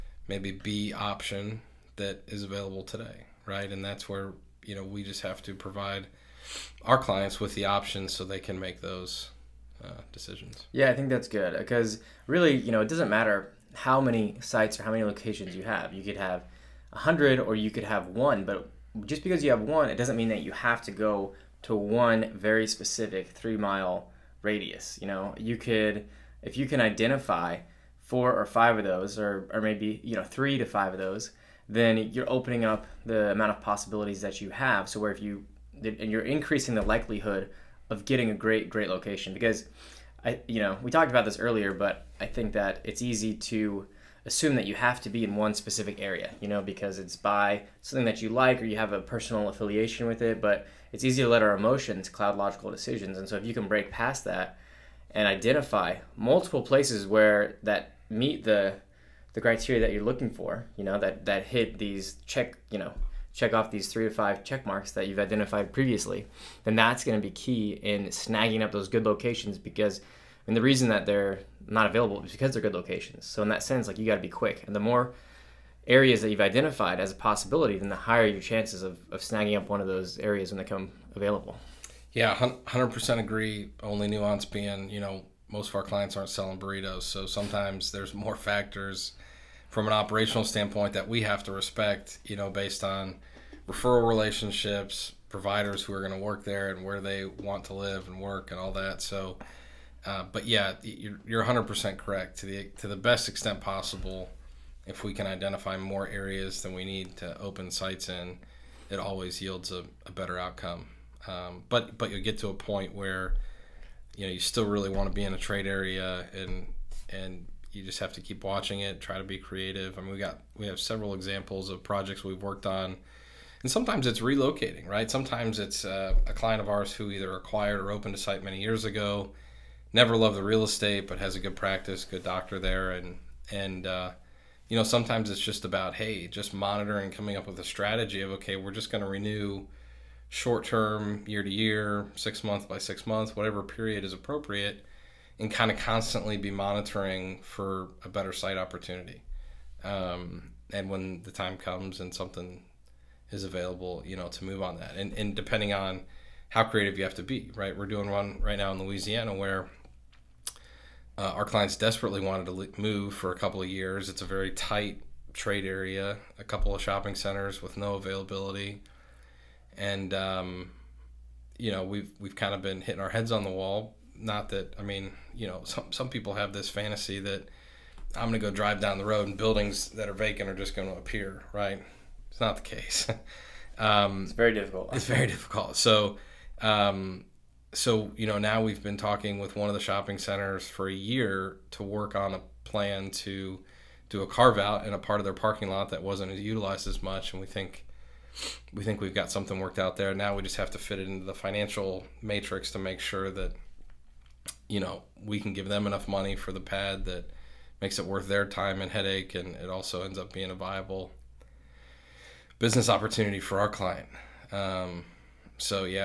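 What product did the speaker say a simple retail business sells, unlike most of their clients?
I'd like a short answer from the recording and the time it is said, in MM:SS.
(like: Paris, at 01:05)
Burritos, at 01:26.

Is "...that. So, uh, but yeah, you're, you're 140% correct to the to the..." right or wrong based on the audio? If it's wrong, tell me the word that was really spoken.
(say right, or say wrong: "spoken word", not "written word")
wrong: "100", not "140".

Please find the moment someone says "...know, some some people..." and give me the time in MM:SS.
02:55.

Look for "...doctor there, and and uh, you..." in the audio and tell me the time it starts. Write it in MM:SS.
02:12.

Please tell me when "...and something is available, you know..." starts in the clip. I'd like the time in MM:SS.
02:31.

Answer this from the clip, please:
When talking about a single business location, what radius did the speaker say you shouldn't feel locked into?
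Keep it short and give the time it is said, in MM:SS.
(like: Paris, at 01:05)
3 mile radius, at 00:23.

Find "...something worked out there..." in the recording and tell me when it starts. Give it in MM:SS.
03:19.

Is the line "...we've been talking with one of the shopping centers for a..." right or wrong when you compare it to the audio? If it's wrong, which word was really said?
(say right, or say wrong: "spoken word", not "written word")
right.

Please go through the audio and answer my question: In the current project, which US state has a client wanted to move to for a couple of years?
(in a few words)
Louisiana.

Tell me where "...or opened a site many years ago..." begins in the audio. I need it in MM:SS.
02:07.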